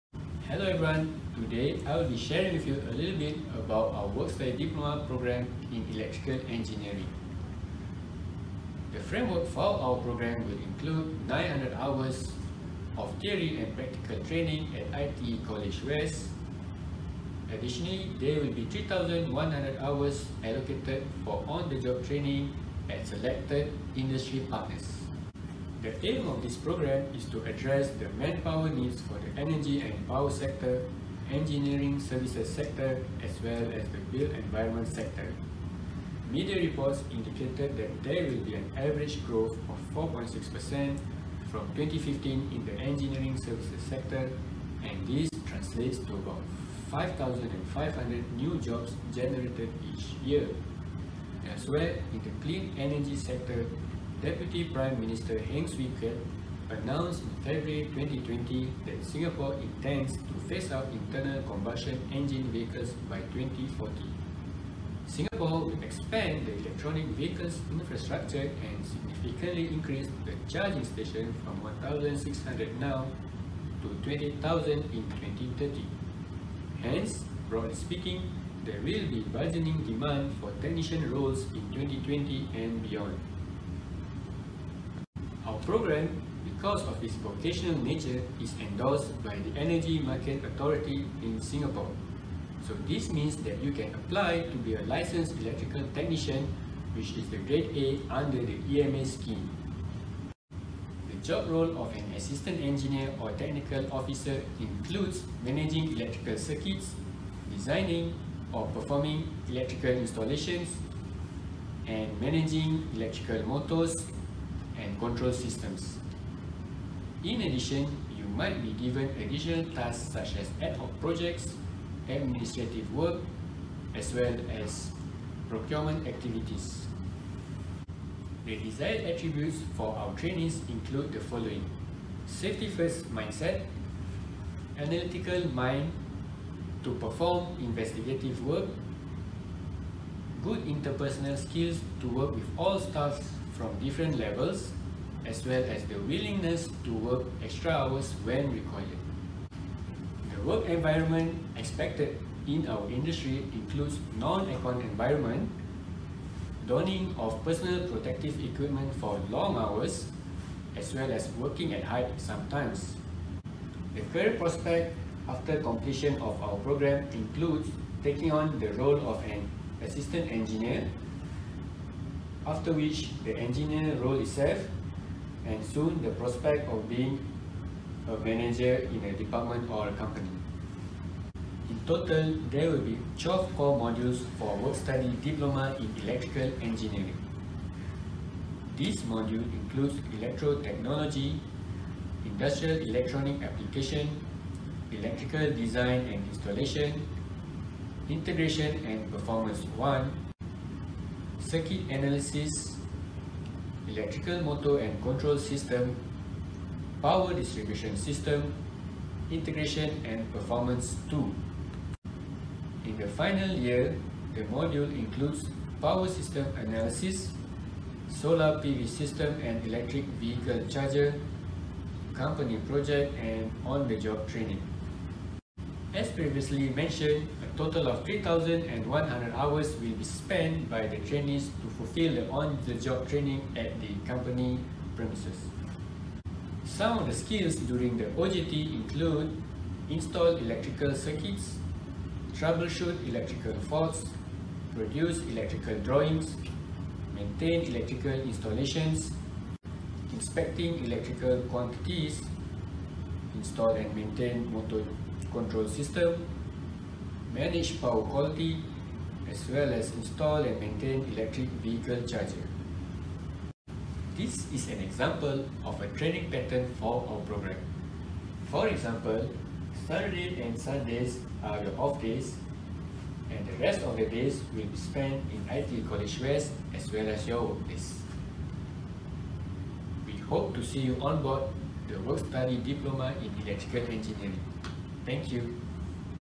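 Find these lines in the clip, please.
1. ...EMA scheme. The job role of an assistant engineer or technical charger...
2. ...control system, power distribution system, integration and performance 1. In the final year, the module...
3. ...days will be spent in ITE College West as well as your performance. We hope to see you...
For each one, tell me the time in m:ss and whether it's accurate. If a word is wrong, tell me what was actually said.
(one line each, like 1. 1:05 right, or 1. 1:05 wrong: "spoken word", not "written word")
1. 1:38 wrong: "officer", not "charger"
2. 3:25 wrong: "2", not "1"
3. 4:34 wrong: "workplace", not "performance".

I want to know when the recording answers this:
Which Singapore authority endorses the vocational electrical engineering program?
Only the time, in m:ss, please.
1:29.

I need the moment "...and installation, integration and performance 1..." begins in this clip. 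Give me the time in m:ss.
3:16.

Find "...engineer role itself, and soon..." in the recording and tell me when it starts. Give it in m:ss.
2:53.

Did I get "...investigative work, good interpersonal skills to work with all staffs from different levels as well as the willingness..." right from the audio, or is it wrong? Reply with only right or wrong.
right.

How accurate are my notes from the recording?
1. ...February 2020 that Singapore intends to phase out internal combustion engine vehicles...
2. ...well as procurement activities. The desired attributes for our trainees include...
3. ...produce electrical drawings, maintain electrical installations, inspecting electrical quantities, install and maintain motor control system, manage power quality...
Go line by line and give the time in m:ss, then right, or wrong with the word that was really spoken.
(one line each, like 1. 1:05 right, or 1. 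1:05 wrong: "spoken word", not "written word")
1. 0:57 right
2. 2:04 right
3. 4:04 right.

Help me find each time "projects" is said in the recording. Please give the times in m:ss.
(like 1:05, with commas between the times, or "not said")
2:00, 3:42.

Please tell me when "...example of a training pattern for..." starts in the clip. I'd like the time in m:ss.
4:24.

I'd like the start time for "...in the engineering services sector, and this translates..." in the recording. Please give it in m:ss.
0:42.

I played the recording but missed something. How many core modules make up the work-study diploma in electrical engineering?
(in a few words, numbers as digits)
12.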